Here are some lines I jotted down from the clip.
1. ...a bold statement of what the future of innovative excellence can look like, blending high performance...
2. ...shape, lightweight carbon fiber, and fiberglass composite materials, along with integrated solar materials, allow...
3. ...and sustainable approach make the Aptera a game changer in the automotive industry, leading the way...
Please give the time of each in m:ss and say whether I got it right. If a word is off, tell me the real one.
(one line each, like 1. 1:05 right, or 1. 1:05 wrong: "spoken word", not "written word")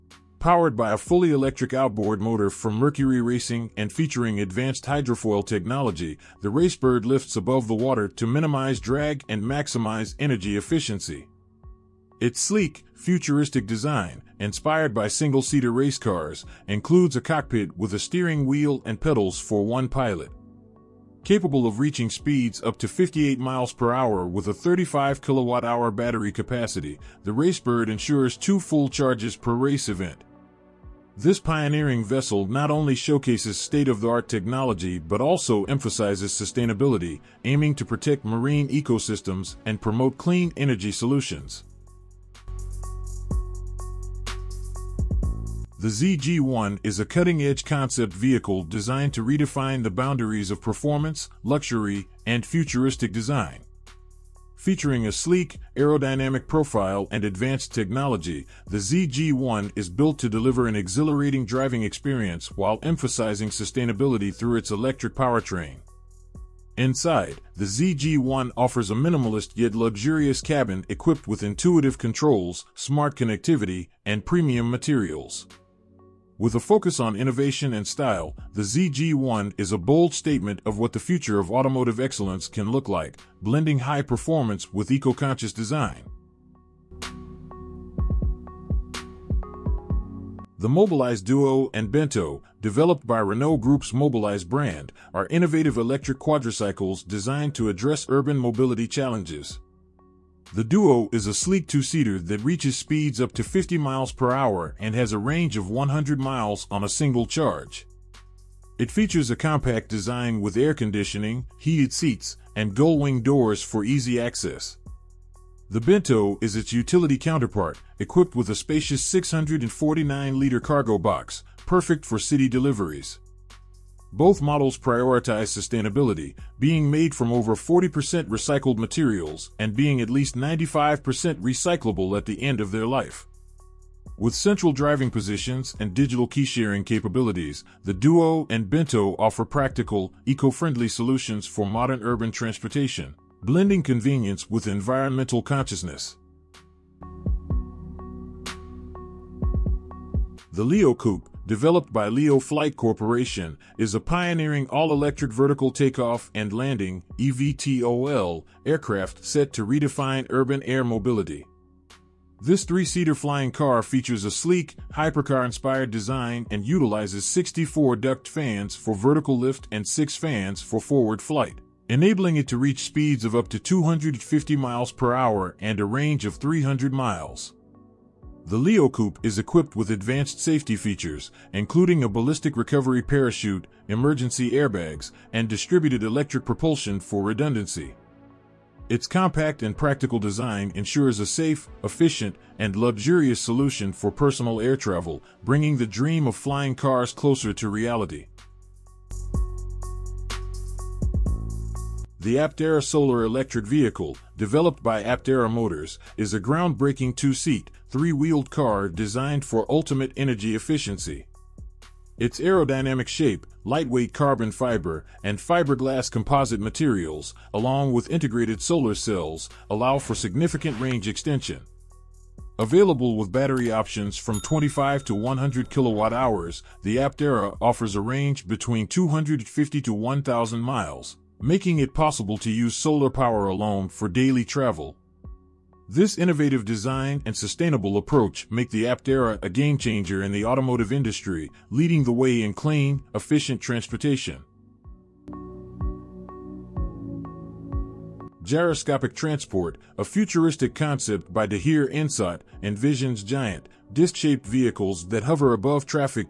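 1. 1:19 wrong: "automotive", not "innovative"
2. 3:33 wrong: "cells", not "materials"
3. 3:57 right.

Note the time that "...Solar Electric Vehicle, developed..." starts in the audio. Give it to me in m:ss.
3:22.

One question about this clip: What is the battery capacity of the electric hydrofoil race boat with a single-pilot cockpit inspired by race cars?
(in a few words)
35 kilowatt-hours.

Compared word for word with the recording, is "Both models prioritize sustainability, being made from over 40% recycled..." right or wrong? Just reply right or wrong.
right.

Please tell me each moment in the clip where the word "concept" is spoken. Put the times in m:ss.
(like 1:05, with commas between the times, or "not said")
0:47, 4:10.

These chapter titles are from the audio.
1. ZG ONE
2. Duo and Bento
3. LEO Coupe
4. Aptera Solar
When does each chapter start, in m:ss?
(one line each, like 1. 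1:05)
1. 0:45
2. 1:30
3. 2:30
4. 3:22.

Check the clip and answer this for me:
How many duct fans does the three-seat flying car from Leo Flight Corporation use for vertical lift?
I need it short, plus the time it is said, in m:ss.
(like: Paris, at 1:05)
64, at 2:47.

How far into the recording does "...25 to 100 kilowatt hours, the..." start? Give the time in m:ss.
3:44.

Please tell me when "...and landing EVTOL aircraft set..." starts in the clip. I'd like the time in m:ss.
2:36.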